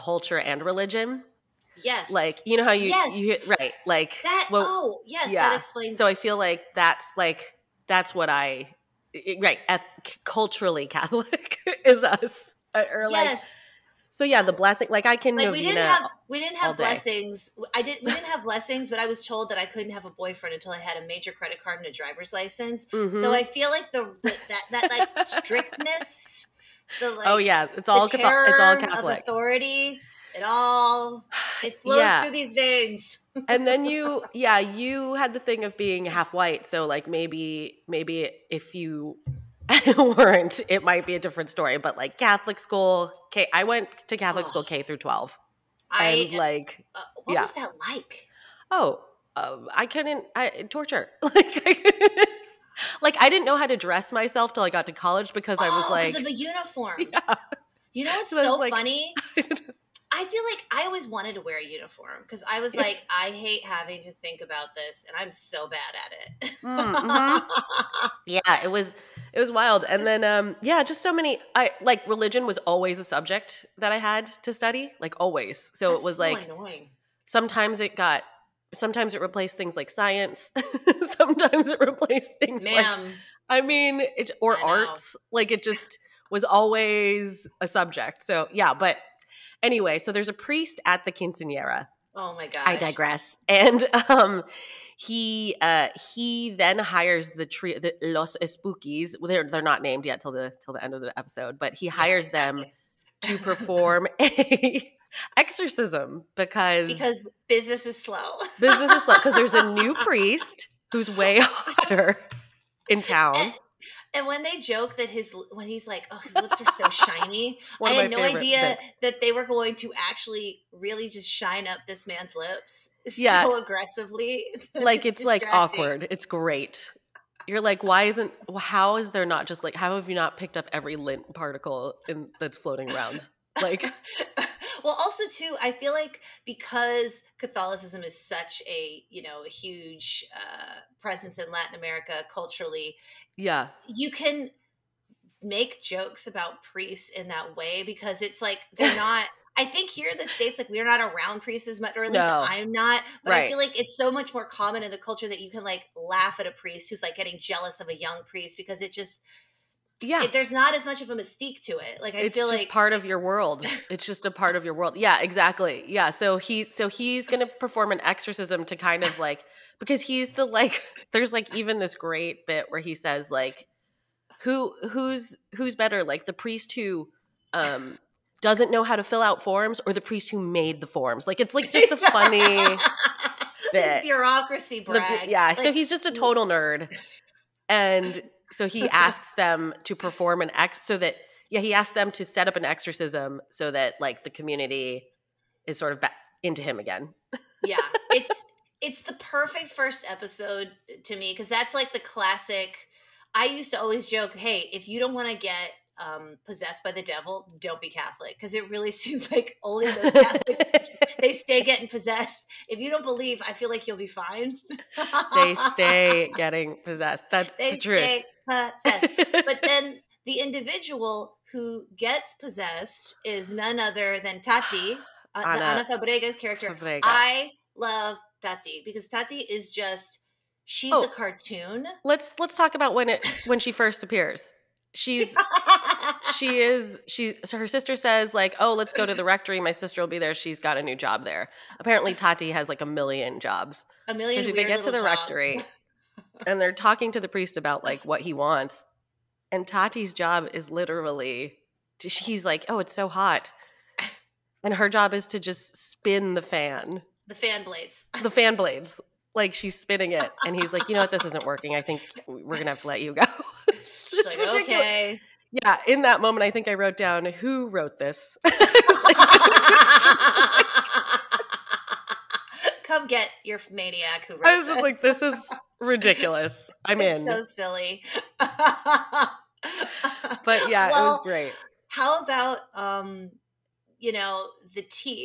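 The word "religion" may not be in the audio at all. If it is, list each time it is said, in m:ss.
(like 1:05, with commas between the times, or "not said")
0:00, 1:12.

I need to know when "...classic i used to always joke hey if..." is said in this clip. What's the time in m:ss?
3:21.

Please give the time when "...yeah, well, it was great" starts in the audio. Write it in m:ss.
4:40.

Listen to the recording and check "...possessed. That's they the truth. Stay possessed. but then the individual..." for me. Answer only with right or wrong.
right.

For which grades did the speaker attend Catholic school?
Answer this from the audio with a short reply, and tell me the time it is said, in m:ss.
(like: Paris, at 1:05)
K through 12, at 0:44.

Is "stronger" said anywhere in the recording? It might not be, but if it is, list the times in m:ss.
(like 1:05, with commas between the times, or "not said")
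not said.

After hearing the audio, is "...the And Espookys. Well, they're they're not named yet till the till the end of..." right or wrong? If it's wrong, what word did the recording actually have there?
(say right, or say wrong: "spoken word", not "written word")
wrong: "Los", not "And".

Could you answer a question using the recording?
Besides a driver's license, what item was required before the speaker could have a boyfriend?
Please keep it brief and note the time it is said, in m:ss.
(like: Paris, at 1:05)
a major credit card, at 0:20.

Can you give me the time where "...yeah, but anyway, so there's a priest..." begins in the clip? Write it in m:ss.
1:28.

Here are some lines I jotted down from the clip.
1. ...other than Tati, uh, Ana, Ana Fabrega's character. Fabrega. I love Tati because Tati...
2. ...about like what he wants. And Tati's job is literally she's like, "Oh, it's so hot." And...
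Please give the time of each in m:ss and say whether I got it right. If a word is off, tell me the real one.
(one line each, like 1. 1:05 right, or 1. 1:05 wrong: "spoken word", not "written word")
1. 3:43 right
2. 4:07 right.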